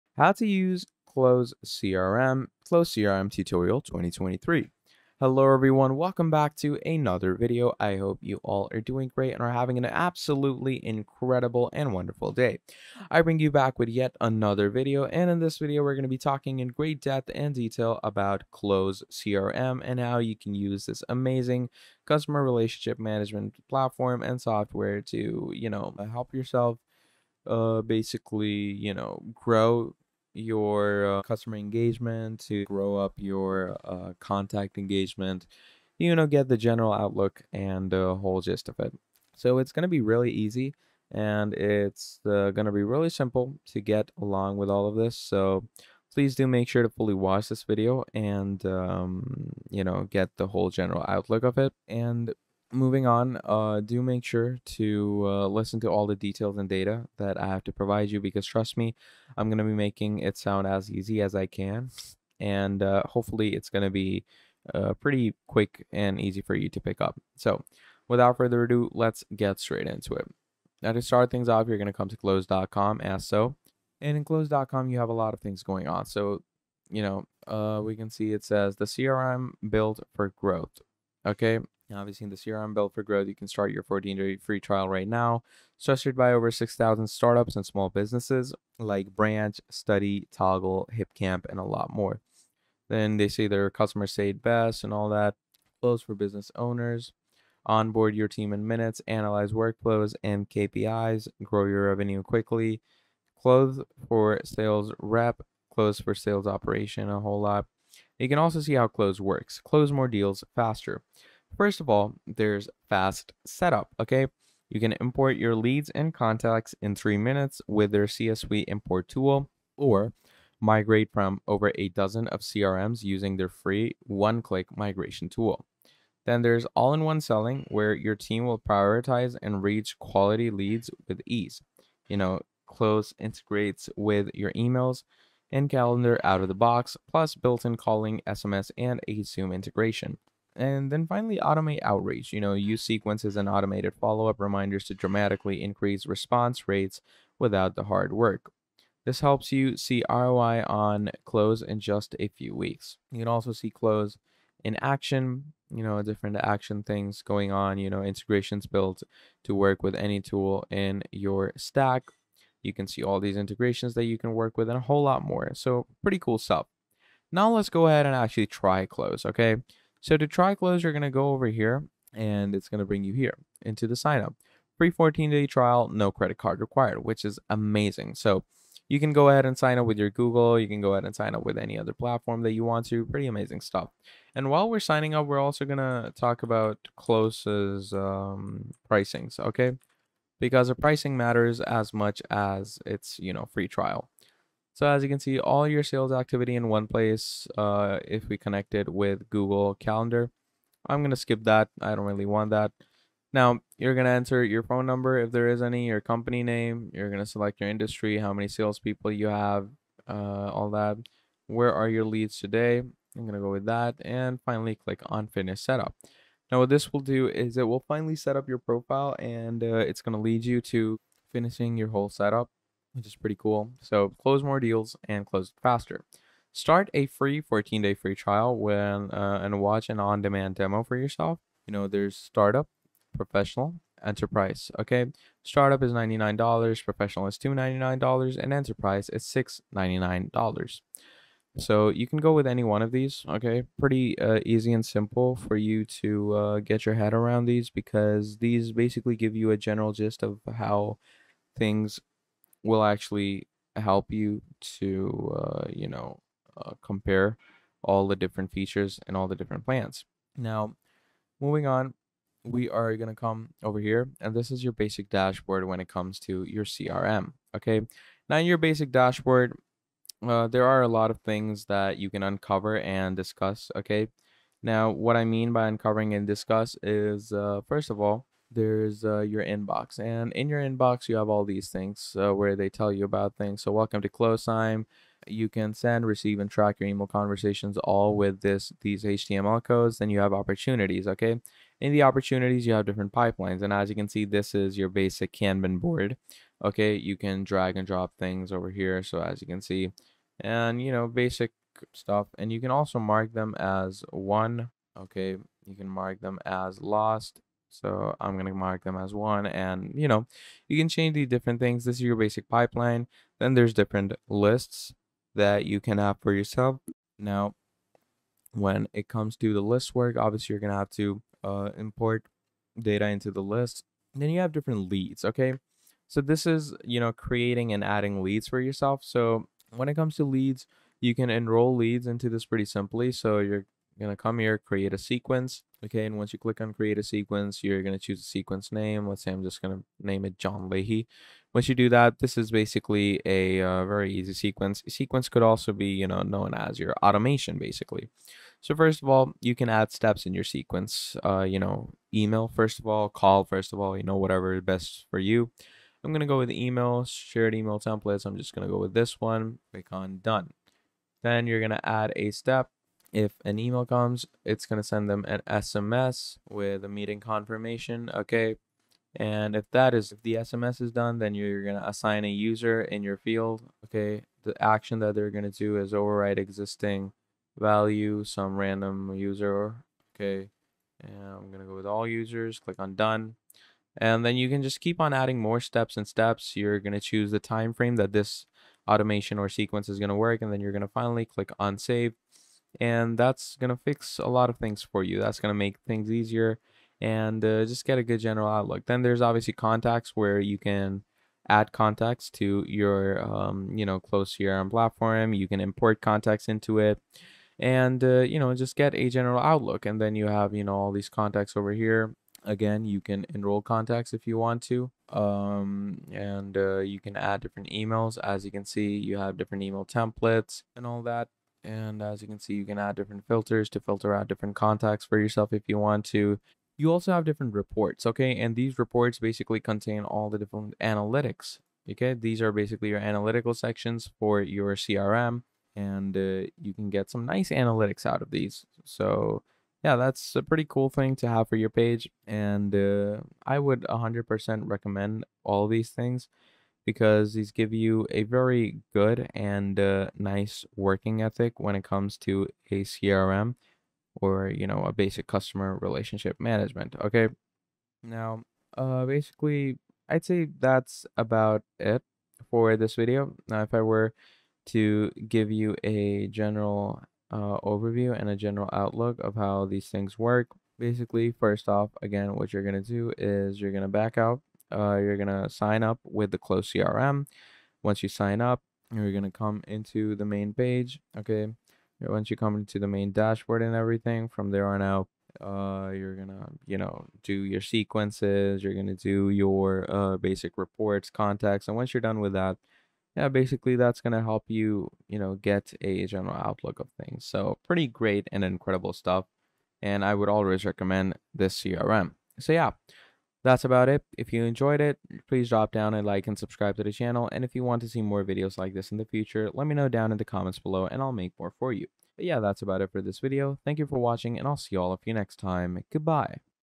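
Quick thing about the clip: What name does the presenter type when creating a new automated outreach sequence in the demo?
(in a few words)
John Leahy.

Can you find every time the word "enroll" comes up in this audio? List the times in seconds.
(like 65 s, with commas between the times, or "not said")
331 s, 413 s.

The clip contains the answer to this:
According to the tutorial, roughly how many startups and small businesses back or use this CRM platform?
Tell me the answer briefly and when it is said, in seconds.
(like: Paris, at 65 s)
6,000, at 86 s.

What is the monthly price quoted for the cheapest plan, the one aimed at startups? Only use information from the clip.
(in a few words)
$99.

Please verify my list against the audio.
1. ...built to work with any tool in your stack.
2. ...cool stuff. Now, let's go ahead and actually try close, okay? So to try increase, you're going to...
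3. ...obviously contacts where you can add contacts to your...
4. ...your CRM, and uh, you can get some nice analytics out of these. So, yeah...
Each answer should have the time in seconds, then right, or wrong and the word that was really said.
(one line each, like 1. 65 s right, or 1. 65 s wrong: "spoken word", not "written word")
1. 158 s right
2. 166 s wrong: "close", not "increase"
3. 399 s right
4. 434 s right.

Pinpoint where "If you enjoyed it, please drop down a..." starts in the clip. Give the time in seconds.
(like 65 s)
504 s.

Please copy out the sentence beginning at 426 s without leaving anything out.
You also have different reports, okay?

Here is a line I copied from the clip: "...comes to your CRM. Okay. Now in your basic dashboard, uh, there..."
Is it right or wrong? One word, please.
right.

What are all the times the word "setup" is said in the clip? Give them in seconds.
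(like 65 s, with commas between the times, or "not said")
113 s, 215 s, 222 s.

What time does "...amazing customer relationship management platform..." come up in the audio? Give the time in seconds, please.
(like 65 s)
21 s.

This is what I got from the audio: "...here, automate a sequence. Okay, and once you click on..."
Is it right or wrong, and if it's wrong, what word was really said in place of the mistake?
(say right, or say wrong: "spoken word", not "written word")
wrong: "create", not "automate".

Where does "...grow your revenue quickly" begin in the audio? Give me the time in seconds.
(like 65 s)
101 s.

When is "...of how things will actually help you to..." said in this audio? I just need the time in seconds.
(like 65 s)
250 s.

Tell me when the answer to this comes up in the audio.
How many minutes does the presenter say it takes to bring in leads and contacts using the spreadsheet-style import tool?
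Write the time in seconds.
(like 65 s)
116 s.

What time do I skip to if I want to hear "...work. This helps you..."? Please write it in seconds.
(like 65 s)
148 s.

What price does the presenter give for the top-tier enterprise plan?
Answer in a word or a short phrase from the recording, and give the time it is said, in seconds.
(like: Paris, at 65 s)
$699, at 239 s.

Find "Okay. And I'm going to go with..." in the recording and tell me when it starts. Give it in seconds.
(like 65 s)
380 s.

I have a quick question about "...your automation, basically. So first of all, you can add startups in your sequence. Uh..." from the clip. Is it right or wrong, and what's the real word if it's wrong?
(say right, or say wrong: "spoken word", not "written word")
wrong: "steps", not "startups".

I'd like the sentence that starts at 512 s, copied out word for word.
But yeah, that's about it for this video.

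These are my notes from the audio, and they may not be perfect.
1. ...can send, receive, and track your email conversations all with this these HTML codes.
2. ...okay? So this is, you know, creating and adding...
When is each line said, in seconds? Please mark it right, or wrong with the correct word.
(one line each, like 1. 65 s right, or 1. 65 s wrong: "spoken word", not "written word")
1. 285 s right
2. 325 s right.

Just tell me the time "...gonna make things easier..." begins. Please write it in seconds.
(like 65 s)
395 s.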